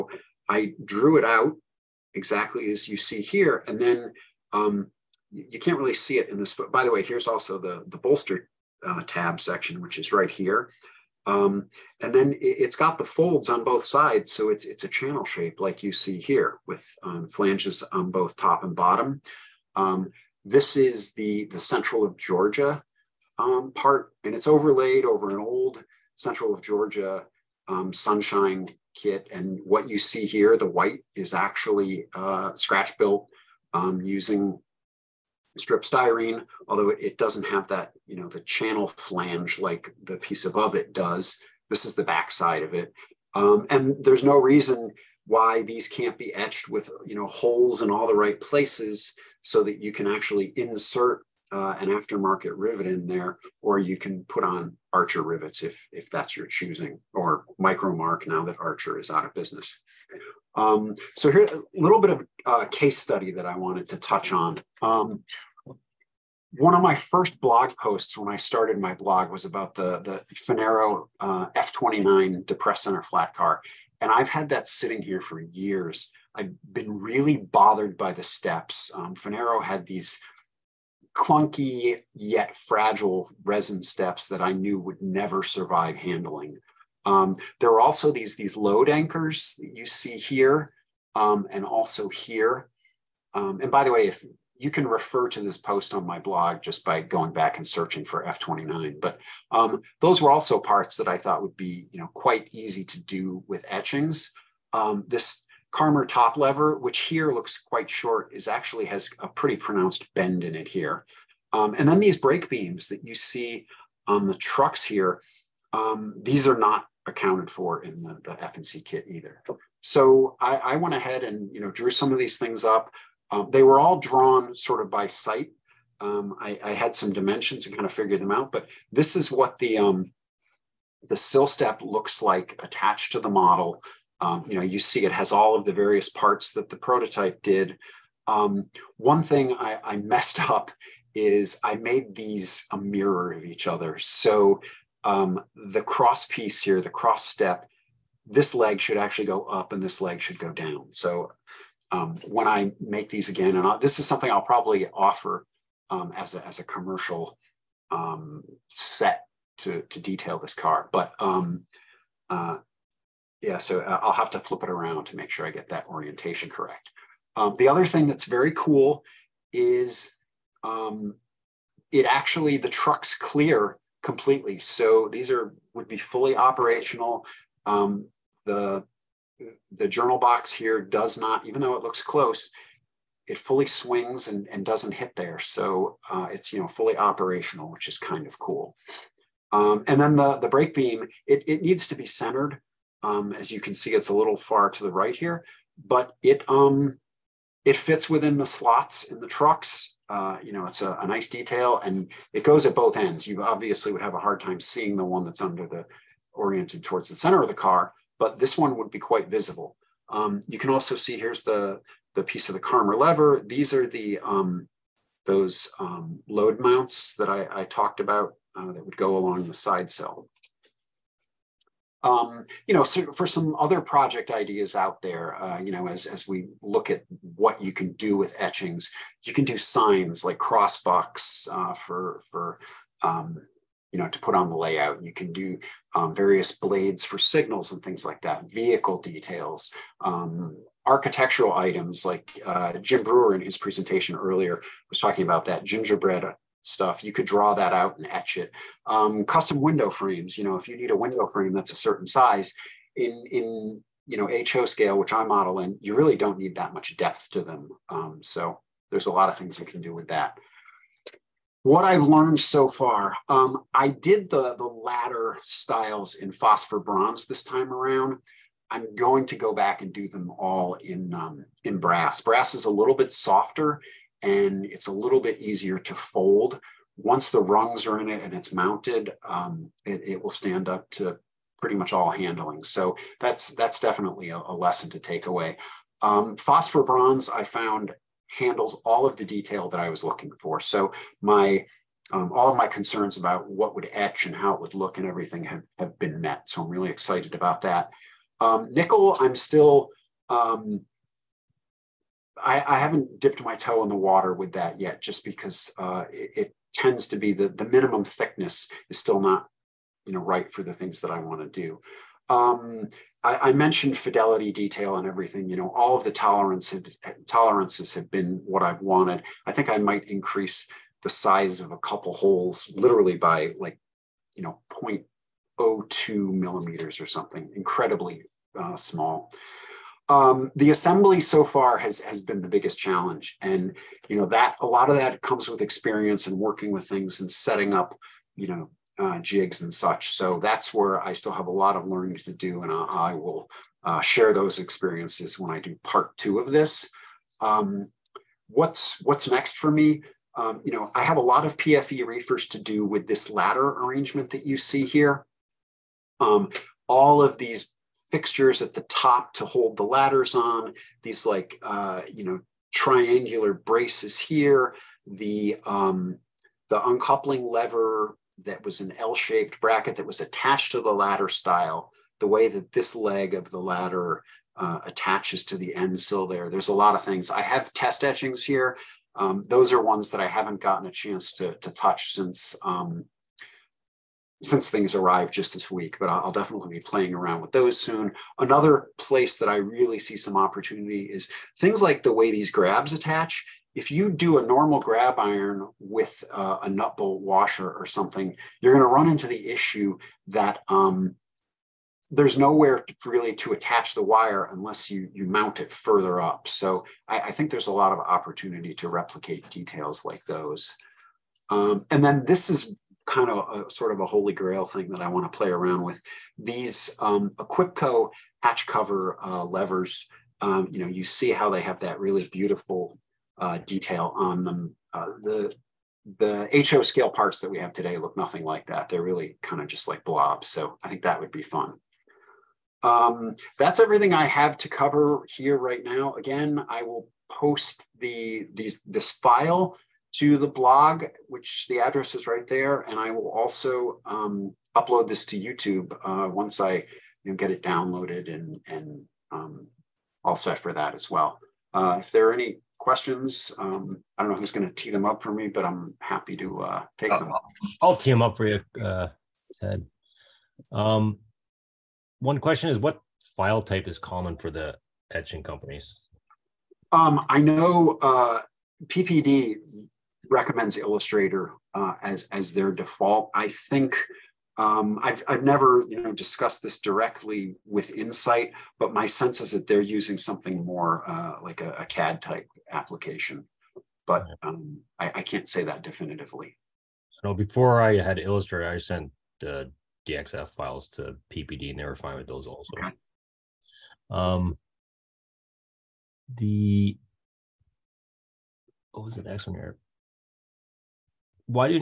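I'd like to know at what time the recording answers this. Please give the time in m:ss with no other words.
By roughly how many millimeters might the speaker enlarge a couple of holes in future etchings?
5:25.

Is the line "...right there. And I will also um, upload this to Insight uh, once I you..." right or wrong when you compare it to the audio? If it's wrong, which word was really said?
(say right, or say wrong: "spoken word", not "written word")
wrong: "YouTube", not "Insight".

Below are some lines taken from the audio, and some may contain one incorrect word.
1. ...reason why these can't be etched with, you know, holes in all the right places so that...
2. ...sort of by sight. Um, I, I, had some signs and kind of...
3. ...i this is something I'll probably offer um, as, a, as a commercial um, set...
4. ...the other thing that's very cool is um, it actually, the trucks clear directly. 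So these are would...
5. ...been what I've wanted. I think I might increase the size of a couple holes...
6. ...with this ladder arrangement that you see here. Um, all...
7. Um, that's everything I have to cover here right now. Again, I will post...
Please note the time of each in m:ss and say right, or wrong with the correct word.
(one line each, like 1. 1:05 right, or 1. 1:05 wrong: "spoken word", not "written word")
1. 0:44 right
2. 2:04 wrong: "dimensions", not "signs"
3. 2:33 right
4. 2:47 wrong: "completely", not "directly"
5. 5:18 right
6. 5:52 right
7. 7:12 right.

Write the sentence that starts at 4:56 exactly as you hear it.
So I'm really excited about that.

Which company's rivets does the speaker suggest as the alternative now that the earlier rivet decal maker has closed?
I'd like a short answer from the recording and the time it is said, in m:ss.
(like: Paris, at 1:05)
Micromark, at 0:57.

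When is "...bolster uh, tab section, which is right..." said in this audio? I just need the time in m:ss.
0:07.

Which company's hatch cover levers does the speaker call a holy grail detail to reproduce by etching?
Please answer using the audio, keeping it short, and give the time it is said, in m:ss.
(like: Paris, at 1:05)
Equipco, at 6:57.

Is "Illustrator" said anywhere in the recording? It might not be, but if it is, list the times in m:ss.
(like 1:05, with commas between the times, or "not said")
7:50, 8:08.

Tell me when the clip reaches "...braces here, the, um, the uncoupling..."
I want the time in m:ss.
6:03.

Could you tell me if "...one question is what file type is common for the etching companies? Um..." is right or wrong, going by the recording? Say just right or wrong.
right.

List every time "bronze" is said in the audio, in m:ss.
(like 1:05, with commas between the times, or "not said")
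4:26, 4:46.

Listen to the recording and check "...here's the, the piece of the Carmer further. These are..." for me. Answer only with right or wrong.
wrong.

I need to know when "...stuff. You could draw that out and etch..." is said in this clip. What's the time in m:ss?
4:06.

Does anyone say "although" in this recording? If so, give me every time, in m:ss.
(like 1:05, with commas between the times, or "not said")
0:36.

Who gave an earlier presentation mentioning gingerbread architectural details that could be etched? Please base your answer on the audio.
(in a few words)
Jim Brewer.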